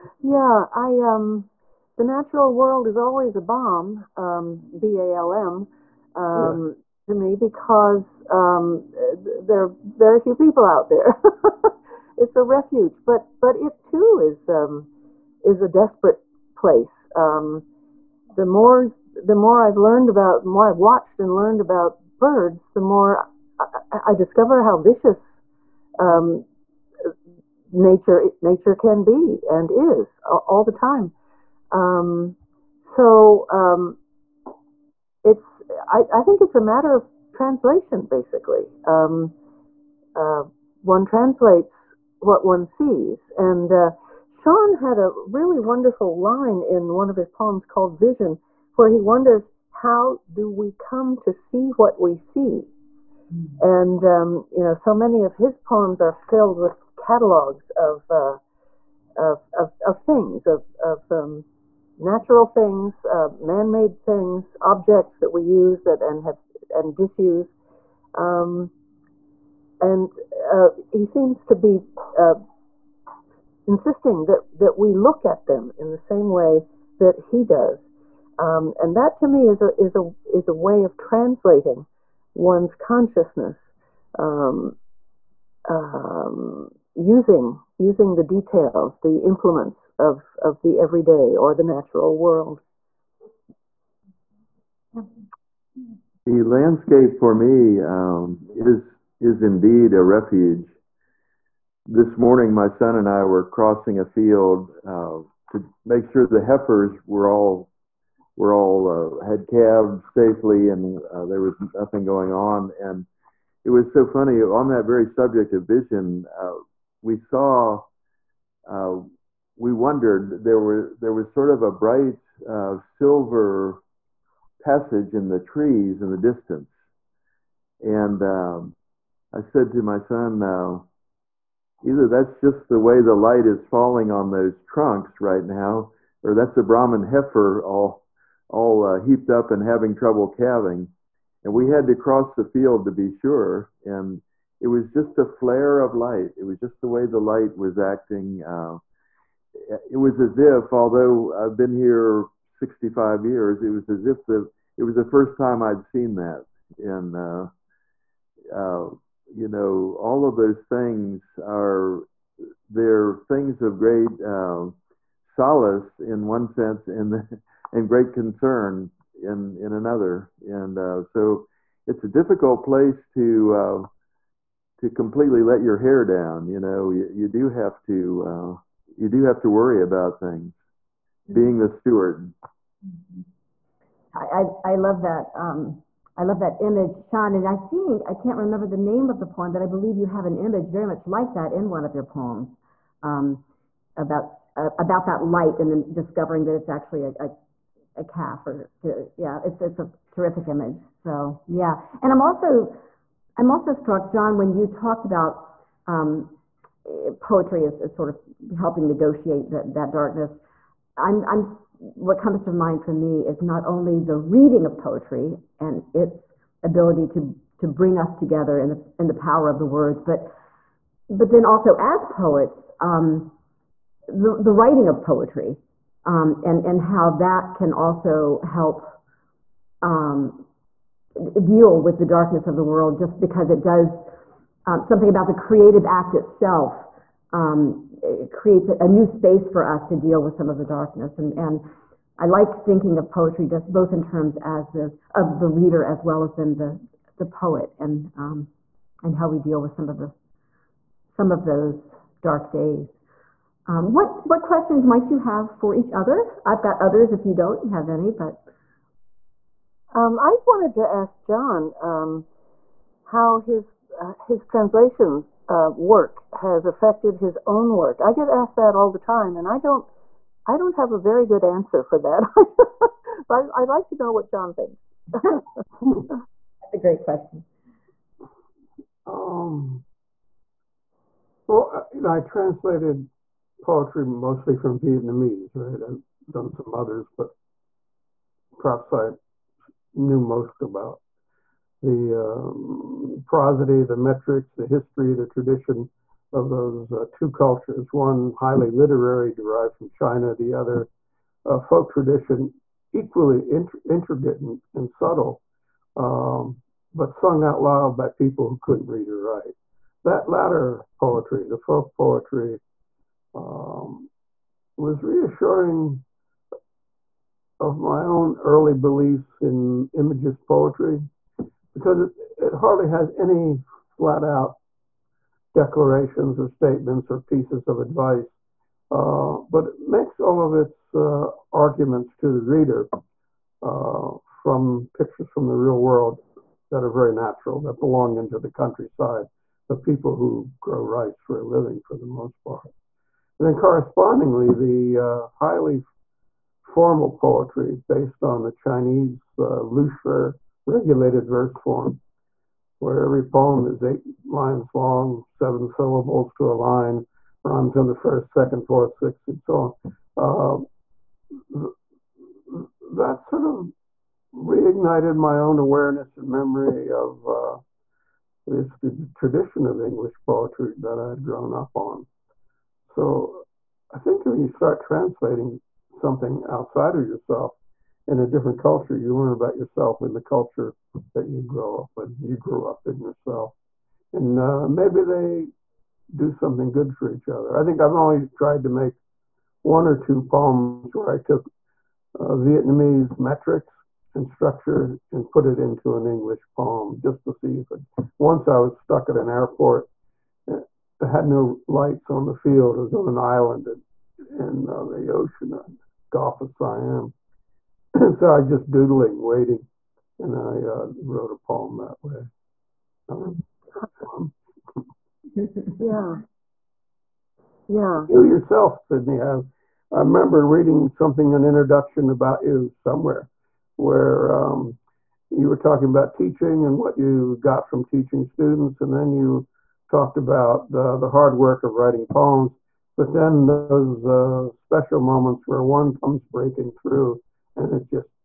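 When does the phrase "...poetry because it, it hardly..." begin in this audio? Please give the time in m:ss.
5:20.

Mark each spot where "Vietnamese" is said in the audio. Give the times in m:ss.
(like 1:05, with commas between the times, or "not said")
4:44, 6:32.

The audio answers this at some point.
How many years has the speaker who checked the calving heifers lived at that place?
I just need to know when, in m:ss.
2:32.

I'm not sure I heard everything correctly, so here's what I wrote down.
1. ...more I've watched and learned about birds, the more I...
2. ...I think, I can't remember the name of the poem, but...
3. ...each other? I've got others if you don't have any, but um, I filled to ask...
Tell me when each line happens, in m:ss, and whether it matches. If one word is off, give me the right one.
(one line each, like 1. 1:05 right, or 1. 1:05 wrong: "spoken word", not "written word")
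1. 0:20 right
2. 3:07 right
3. 4:15 wrong: "wanted", not "filled".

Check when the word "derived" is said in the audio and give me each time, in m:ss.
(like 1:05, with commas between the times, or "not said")
4:59.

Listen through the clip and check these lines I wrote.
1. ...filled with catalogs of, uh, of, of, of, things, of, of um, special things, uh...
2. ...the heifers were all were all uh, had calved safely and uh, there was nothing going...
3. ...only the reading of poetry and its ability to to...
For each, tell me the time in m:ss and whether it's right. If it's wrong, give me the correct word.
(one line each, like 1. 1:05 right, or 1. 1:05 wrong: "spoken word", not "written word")
1. 0:56 wrong: "natural", not "special"
2. 1:46 right
3. 3:33 right.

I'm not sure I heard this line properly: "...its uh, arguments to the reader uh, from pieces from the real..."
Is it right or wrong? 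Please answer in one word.
wrong.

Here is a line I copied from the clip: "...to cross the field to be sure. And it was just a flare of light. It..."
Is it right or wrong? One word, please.
right.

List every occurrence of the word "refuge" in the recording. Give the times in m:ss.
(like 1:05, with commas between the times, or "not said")
0:12, 1:40.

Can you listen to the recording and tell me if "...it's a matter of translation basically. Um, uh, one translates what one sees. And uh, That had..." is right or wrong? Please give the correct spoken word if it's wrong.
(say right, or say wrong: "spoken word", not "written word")
wrong: "Sean", not "That".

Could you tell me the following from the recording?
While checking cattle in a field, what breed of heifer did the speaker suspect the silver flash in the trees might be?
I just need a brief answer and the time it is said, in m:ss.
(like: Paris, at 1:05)
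Brahman, at 2:16.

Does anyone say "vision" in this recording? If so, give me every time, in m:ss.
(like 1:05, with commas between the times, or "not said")
0:47, 1:55.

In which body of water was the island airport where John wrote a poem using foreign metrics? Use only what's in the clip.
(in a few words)
Gulf of Siam.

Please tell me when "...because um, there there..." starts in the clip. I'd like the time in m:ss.
0:07.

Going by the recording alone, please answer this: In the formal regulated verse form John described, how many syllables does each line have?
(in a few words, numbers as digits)
7.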